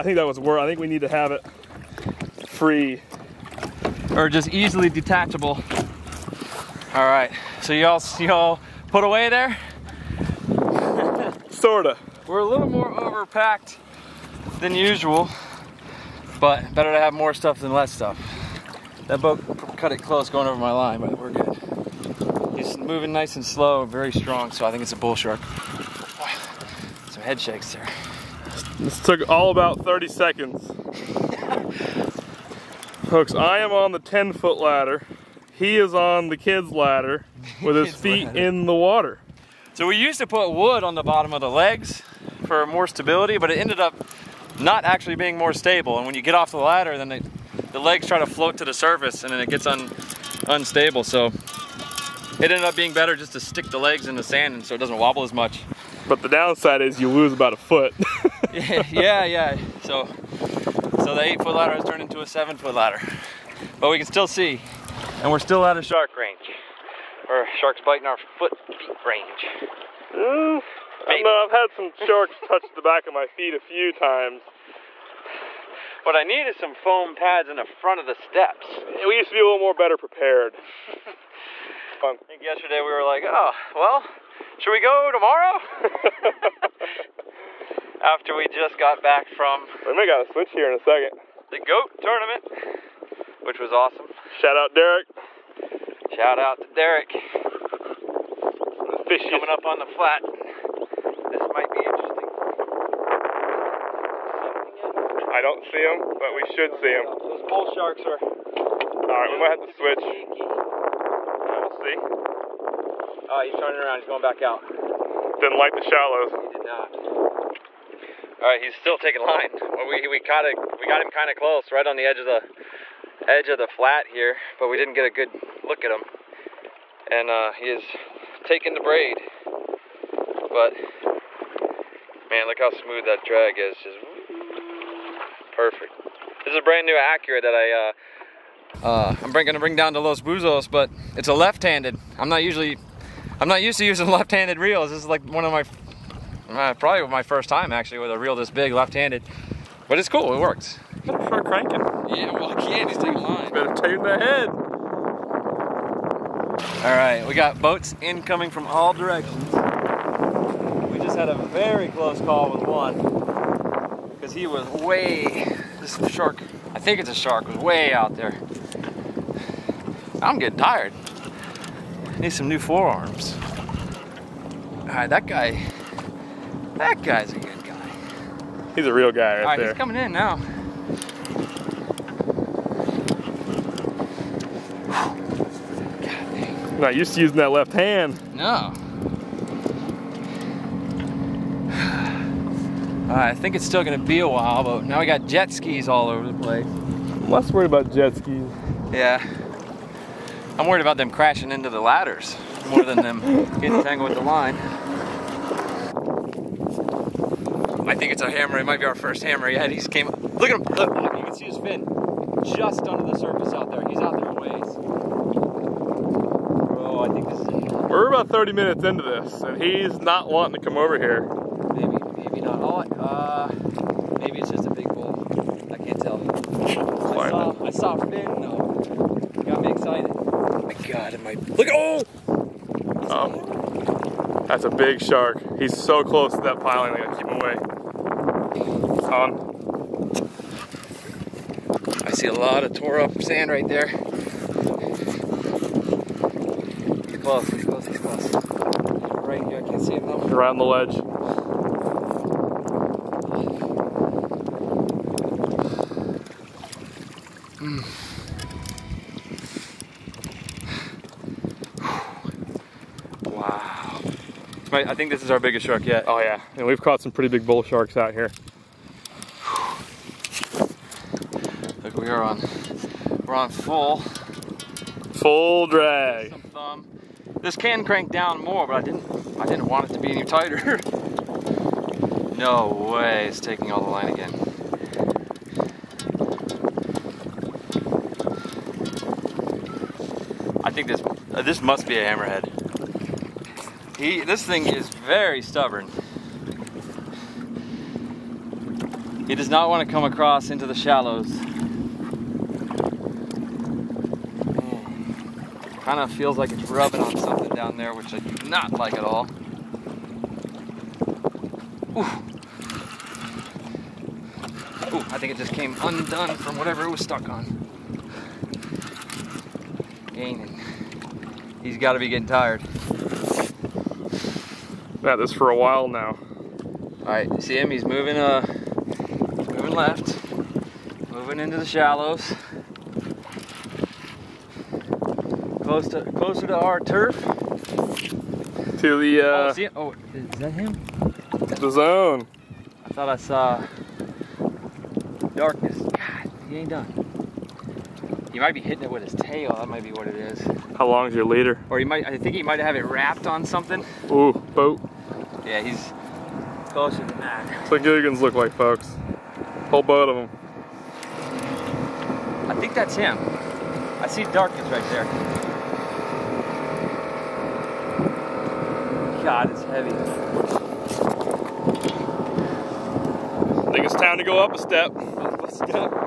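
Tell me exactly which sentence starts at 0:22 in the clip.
He's moving nice and slow, very strong, so I think it's a bull shark.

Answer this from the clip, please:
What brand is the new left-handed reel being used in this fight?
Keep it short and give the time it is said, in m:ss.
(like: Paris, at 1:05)
Accurate, at 2:16.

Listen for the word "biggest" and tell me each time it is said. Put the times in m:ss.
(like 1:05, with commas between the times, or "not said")
4:25.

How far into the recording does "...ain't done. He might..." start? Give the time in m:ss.
5:46.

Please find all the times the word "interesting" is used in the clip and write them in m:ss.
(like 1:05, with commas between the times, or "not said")
1:41.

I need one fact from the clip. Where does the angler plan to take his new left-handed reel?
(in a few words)
Los Buzos.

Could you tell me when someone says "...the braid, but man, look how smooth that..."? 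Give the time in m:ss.
2:08.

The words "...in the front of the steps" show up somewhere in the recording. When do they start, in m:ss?
1:17.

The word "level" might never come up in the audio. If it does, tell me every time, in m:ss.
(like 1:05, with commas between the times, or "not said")
not said.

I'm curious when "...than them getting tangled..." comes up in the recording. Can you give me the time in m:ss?
3:22.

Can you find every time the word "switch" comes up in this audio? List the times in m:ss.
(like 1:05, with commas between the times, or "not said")
1:30, 1:49.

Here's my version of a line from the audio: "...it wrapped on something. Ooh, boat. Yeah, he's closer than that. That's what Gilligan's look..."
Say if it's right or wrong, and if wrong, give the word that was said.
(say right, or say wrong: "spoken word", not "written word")
right.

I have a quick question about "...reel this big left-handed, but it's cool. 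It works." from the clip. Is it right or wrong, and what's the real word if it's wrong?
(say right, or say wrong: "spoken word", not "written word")
right.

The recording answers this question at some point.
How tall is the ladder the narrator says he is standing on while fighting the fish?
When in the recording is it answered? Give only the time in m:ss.
0:33.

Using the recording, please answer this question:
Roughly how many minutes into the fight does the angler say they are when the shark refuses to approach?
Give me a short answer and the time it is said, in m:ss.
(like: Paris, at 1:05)
30 minutes, at 3:38.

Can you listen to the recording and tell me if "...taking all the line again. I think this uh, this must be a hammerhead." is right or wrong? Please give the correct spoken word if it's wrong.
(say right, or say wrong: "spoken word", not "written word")
right.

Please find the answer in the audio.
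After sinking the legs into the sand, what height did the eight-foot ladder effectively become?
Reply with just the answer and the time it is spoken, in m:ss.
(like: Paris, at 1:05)
7 foot, at 1:02.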